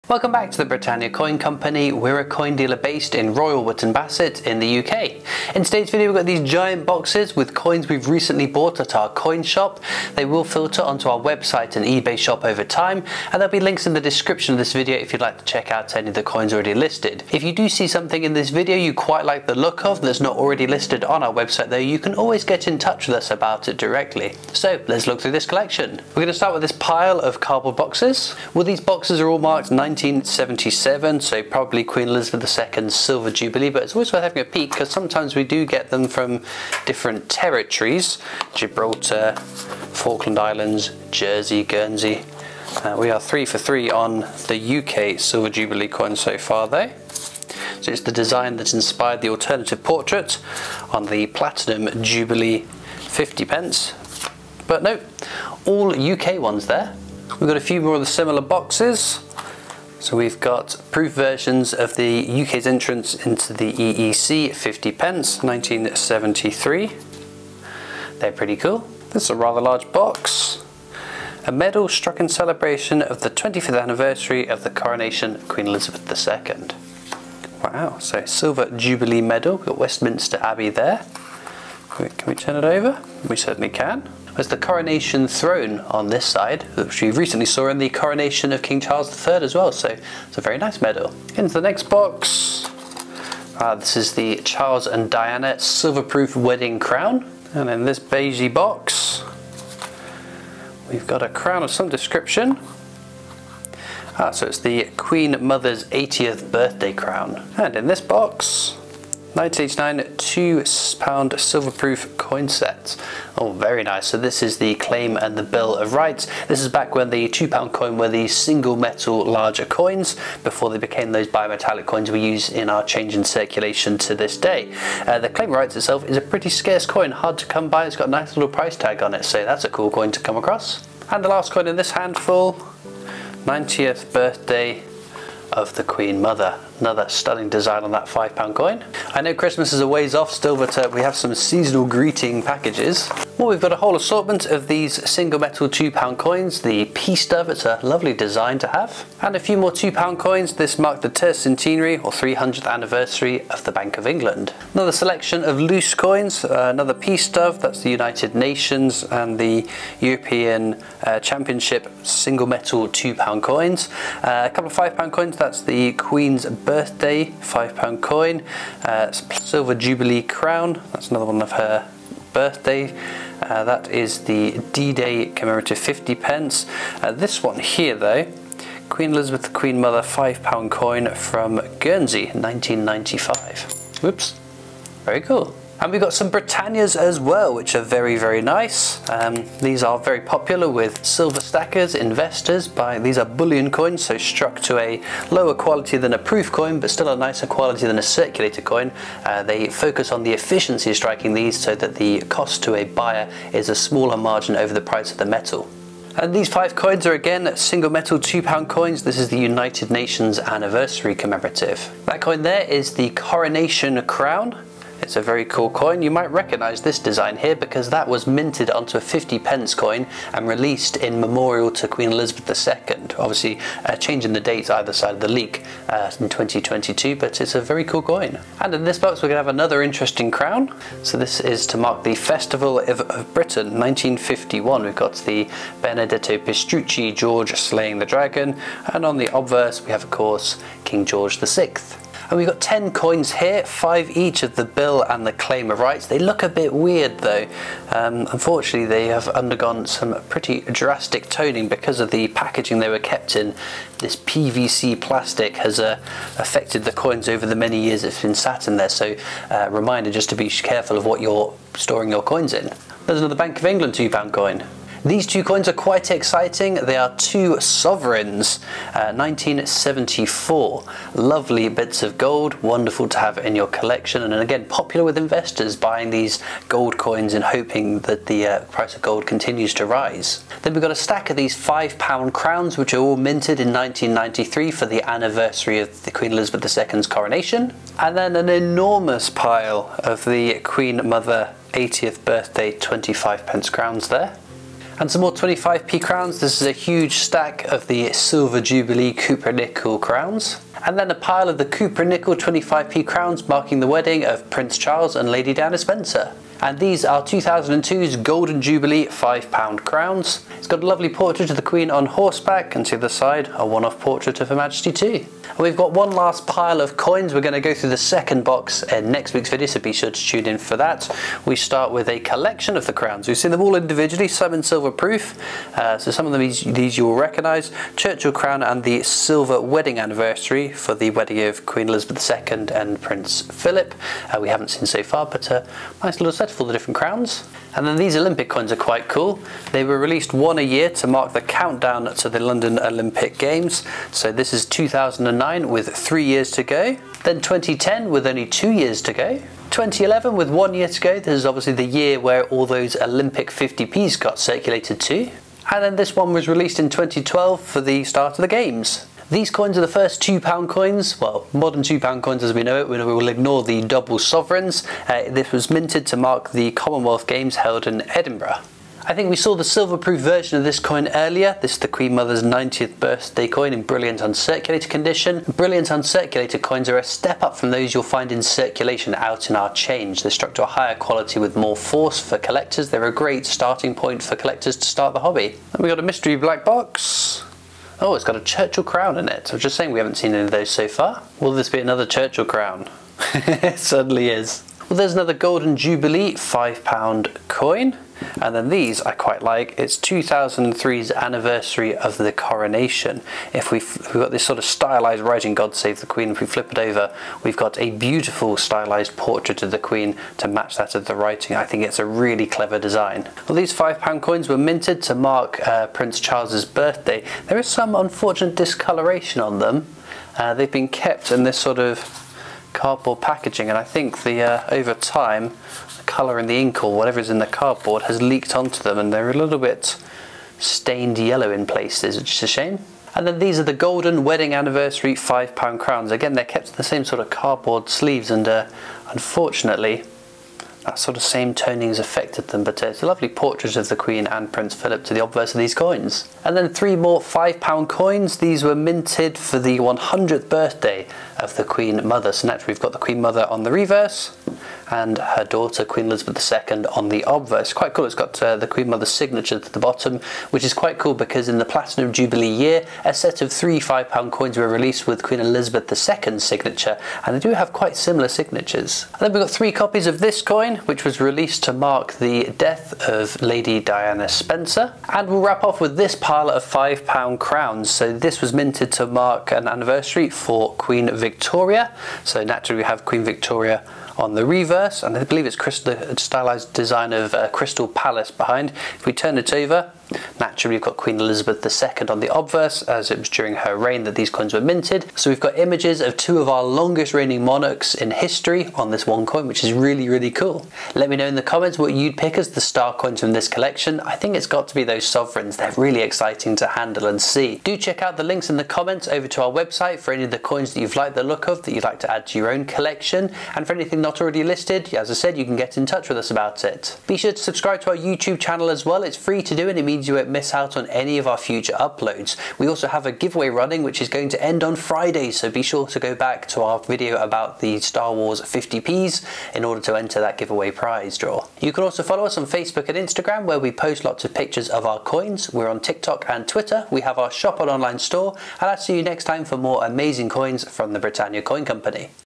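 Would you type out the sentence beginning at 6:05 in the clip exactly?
Uh, this was minted to mark the Commonwealth Games held in Edinburgh.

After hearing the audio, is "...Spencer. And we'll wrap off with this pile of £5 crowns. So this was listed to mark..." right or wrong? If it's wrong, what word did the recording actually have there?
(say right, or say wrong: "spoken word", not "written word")
wrong: "minted", not "listed".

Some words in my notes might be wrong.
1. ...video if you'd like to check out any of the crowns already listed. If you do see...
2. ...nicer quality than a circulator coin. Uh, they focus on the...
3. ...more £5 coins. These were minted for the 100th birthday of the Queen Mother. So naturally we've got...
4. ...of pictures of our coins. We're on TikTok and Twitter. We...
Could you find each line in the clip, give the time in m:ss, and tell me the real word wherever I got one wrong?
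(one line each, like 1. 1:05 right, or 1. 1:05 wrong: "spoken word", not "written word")
1. 0:14 wrong: "coins", not "crowns"
2. 3:17 right
3. 7:26 right
4. 8:54 right.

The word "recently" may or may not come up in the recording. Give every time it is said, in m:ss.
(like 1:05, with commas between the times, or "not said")
0:08, 1:27.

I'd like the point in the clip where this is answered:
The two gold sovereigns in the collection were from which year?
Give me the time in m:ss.
4:29.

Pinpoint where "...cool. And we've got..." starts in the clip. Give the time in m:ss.
3:05.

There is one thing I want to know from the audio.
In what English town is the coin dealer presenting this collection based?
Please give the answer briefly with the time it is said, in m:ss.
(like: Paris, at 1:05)
Royal Wootton Bassett, at 0:03.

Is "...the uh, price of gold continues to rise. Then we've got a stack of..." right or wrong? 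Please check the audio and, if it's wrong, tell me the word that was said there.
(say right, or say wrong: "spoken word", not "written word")
right.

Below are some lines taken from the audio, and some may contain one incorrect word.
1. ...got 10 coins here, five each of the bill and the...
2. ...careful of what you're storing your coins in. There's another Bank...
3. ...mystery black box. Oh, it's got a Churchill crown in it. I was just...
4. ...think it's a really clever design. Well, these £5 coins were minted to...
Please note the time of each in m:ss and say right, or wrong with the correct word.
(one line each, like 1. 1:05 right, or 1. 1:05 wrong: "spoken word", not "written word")
1. 4:02 right
2. 4:20 right
3. 6:26 right
4. 6:51 right.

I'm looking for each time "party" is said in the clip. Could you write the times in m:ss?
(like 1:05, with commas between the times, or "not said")
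not said.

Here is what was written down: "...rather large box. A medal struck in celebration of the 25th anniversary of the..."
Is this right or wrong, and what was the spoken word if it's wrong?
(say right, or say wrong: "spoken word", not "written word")
right.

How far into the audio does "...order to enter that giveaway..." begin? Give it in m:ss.
8:49.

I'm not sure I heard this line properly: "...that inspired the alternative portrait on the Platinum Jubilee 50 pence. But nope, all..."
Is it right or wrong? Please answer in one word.
right.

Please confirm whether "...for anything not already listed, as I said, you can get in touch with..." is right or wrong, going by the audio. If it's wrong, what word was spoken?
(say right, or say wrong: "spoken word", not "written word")
right.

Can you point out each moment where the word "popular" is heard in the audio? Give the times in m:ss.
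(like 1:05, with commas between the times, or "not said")
3:10, 4:34.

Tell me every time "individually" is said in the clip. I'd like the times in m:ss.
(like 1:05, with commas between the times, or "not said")
5:23.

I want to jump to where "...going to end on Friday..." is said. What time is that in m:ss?
8:44.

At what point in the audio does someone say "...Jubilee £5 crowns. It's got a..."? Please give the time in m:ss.
5:08.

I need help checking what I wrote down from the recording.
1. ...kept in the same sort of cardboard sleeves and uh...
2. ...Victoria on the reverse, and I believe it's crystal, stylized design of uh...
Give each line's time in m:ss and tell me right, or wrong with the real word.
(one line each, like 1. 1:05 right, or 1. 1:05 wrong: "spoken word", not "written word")
1. 7:16 right
2. 8:03 right.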